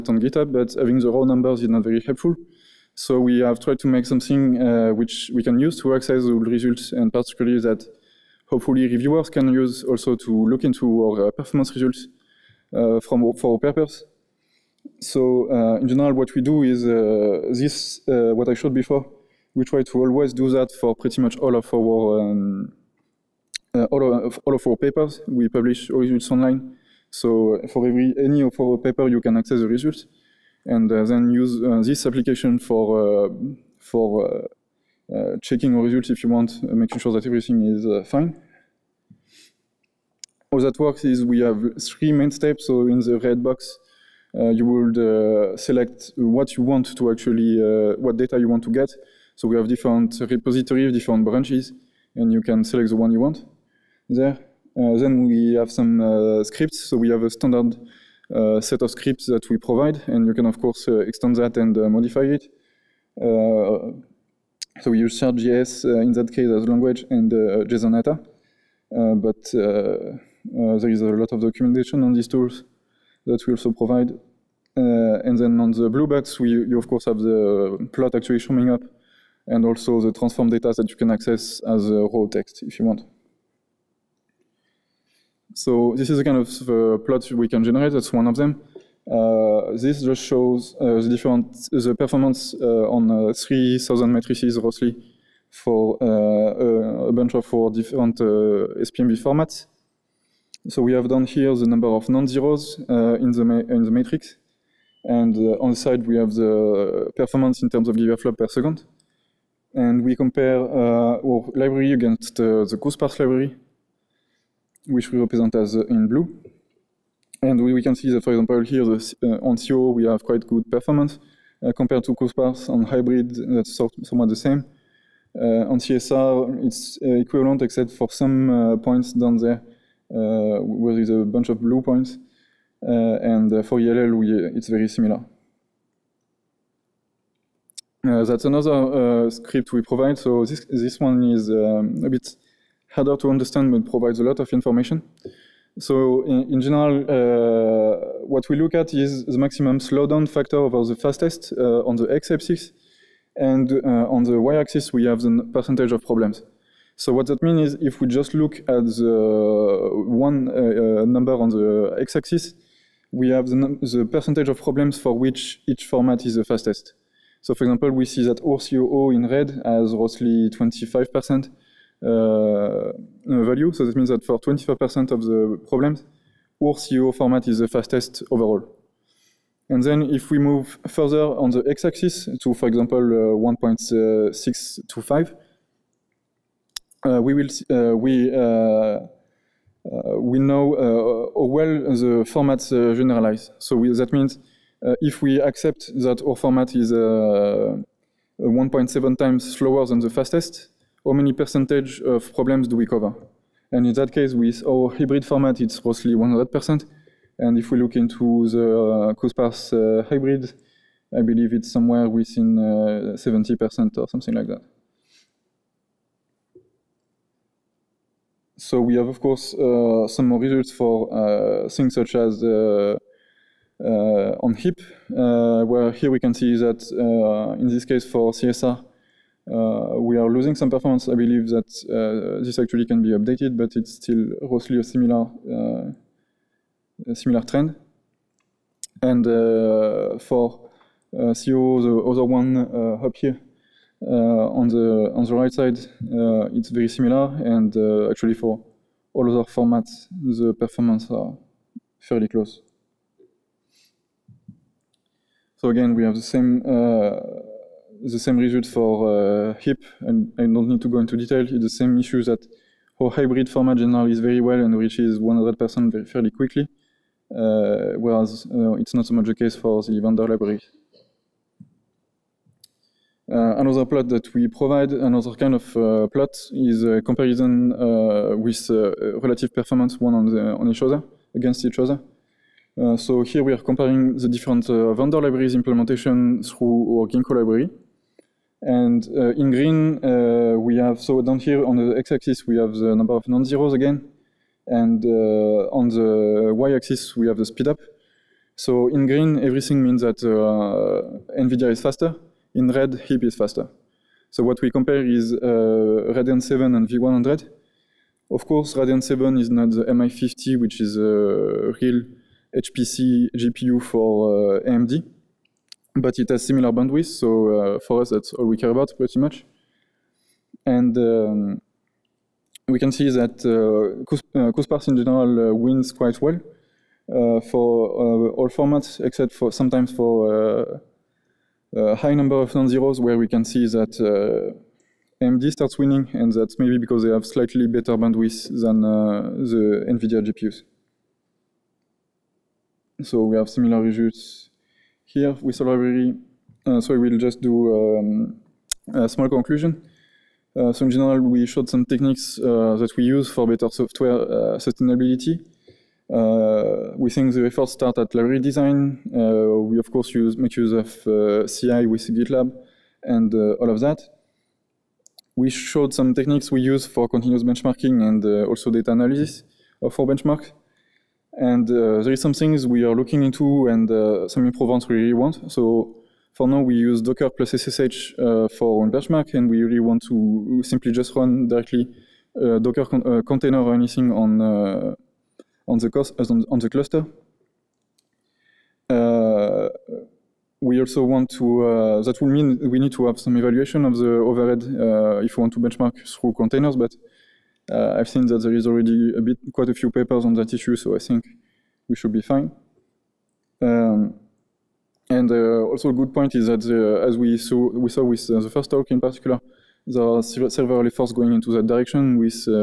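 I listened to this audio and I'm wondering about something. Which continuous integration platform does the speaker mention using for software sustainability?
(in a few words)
GitLab.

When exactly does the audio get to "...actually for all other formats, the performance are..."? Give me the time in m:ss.
4:08.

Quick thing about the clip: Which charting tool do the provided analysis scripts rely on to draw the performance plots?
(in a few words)
Chart.js.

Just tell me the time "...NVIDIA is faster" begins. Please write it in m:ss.
5:01.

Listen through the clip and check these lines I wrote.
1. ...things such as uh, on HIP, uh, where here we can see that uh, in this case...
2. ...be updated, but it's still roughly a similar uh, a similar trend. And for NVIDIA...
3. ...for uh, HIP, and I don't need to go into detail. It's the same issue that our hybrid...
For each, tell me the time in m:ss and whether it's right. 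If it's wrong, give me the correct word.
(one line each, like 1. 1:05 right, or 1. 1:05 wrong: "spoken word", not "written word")
1. 3:41 right
2. 3:53 wrong: "COO", not "NVIDIA"
3. 4:18 right.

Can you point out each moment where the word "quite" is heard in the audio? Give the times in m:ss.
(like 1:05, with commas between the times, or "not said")
2:00, 5:25, 6:39.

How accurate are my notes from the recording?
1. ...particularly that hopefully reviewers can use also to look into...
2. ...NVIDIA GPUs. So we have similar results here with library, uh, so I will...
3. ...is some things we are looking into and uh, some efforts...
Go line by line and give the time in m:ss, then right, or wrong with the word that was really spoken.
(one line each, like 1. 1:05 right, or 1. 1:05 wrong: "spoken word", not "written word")
1. 0:07 right
2. 5:39 right
3. 6:12 wrong: "improvements", not "efforts".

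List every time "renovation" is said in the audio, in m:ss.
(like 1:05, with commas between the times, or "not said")
not said.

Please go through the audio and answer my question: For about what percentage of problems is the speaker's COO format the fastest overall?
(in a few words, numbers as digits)
25%.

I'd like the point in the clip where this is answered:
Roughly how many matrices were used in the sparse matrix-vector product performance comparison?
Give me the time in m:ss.
1:33.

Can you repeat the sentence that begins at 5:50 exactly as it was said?
Uh, so in general, we showed some techniques uh, that we use for better software uh, sustainability.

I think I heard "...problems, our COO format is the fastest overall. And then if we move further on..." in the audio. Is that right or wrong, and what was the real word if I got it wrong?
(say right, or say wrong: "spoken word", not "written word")
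right.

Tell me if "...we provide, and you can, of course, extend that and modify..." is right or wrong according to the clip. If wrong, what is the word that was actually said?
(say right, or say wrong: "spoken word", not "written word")
right.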